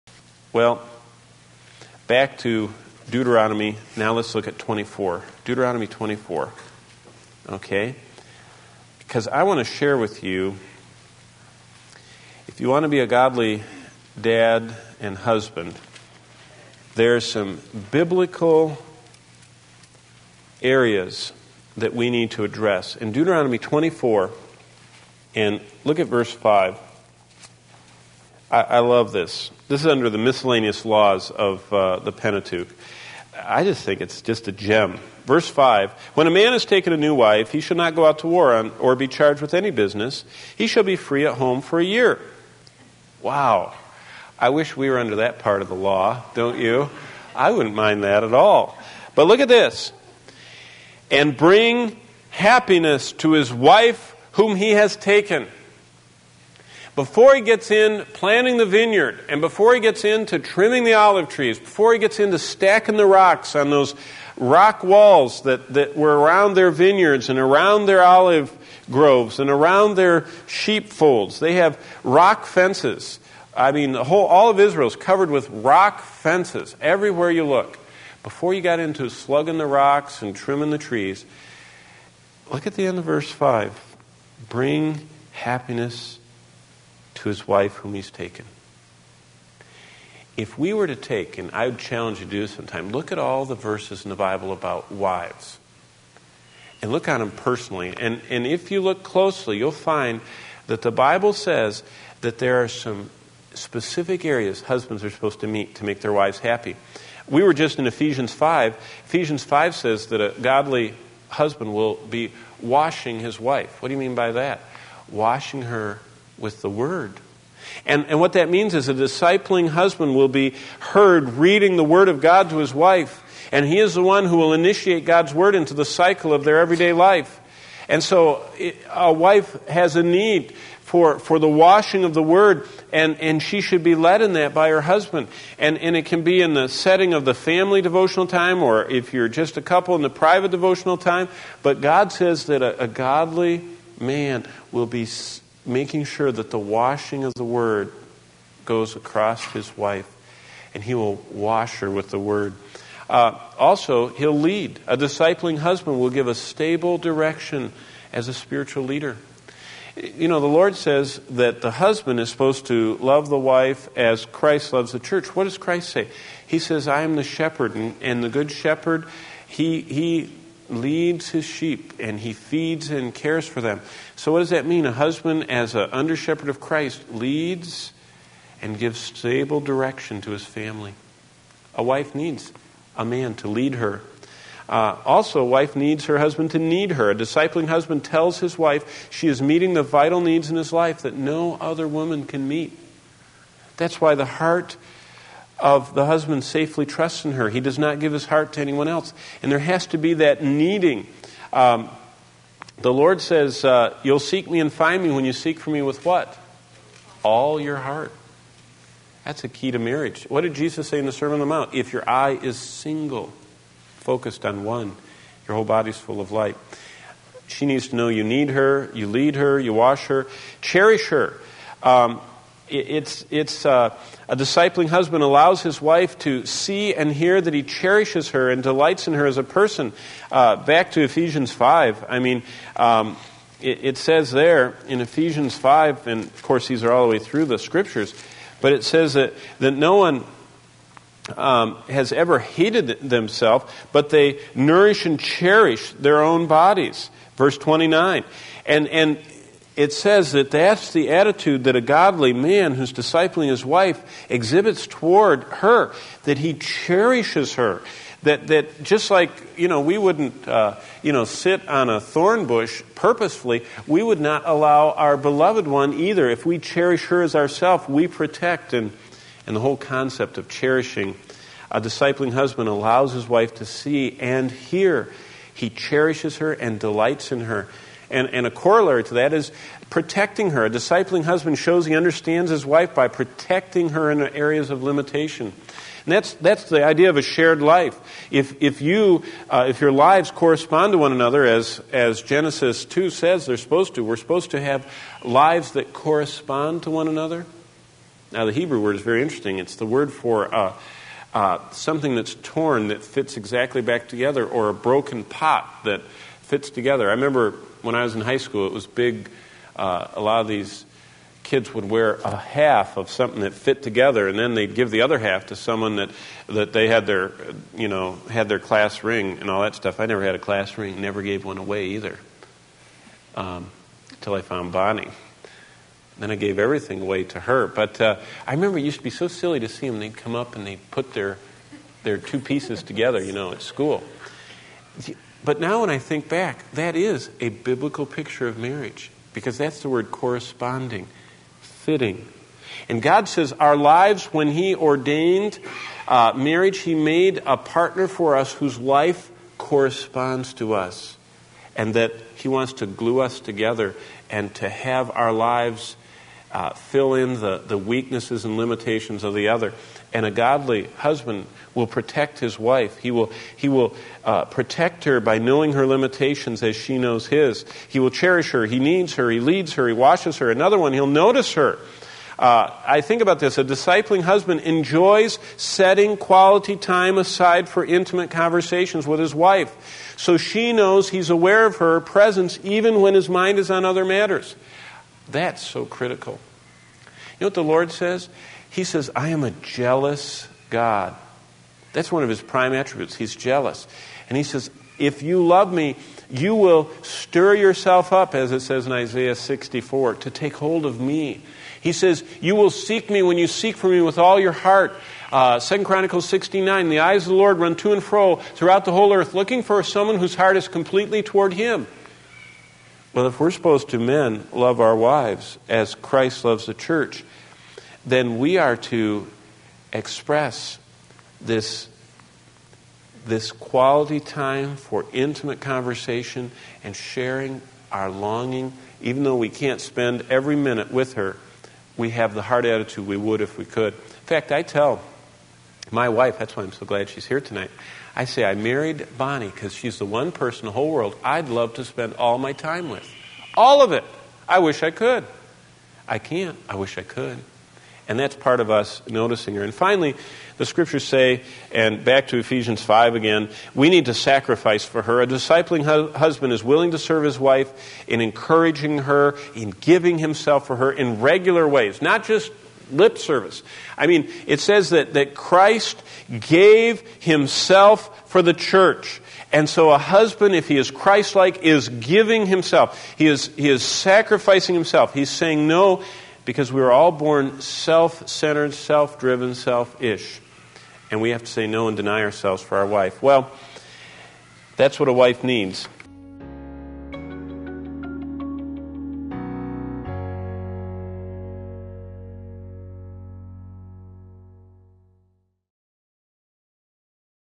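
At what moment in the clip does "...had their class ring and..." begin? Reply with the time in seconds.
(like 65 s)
318 s.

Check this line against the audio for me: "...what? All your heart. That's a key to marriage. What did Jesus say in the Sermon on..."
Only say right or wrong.
right.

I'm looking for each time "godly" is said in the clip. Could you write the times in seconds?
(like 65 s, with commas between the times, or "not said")
13 s, 110 s, 142 s, 251 s, 360 s.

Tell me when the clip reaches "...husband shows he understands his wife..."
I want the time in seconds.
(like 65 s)
281 s.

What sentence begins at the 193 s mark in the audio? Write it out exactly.
That's why the heart of the husband safely trusts in her.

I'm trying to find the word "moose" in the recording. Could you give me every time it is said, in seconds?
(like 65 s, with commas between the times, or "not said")
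not said.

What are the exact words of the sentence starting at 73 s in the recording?
I mean, the whole, all of Israel is covered with rock fences everywhere you look.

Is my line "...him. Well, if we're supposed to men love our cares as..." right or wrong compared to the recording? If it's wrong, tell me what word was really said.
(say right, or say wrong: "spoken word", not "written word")
wrong: "wives", not "cares".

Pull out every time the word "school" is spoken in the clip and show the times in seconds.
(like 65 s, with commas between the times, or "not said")
308 s, 333 s.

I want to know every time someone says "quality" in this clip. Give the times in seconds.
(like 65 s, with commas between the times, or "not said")
376 s, 423 s.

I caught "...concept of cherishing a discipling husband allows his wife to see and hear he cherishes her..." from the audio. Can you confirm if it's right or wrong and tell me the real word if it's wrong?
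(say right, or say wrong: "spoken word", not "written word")
right.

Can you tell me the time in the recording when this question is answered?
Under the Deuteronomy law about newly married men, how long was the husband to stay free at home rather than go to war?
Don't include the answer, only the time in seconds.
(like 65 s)
41 s.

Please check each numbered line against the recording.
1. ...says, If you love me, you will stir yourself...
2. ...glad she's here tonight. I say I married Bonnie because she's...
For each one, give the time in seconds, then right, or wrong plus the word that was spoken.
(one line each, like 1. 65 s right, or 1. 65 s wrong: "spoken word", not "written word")
1. 394 s right
2. 436 s right.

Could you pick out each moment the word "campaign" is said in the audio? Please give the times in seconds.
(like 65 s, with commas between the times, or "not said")
not said.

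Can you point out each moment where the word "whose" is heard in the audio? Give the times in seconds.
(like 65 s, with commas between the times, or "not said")
348 s, 410 s.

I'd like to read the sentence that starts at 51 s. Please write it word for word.
And bring happiness to his wife whom he has taken.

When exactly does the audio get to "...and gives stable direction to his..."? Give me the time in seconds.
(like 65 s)
178 s.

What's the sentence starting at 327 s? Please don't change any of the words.
But uh, I remember it used to be so silly to see them.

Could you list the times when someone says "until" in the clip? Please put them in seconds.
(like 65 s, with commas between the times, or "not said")
324 s.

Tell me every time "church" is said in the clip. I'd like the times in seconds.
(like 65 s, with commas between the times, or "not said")
164 s, 416 s, 468 s.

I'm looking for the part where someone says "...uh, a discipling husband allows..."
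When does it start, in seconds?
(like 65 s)
223 s.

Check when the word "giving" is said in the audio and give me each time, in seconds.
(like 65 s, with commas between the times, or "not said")
459 s, 471 s.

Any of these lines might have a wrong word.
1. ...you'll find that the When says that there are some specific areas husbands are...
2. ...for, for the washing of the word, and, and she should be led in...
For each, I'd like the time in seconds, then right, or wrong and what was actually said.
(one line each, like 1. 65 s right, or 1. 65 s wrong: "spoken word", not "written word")
1. 99 s wrong: "Bible", not "When"
2. 130 s right.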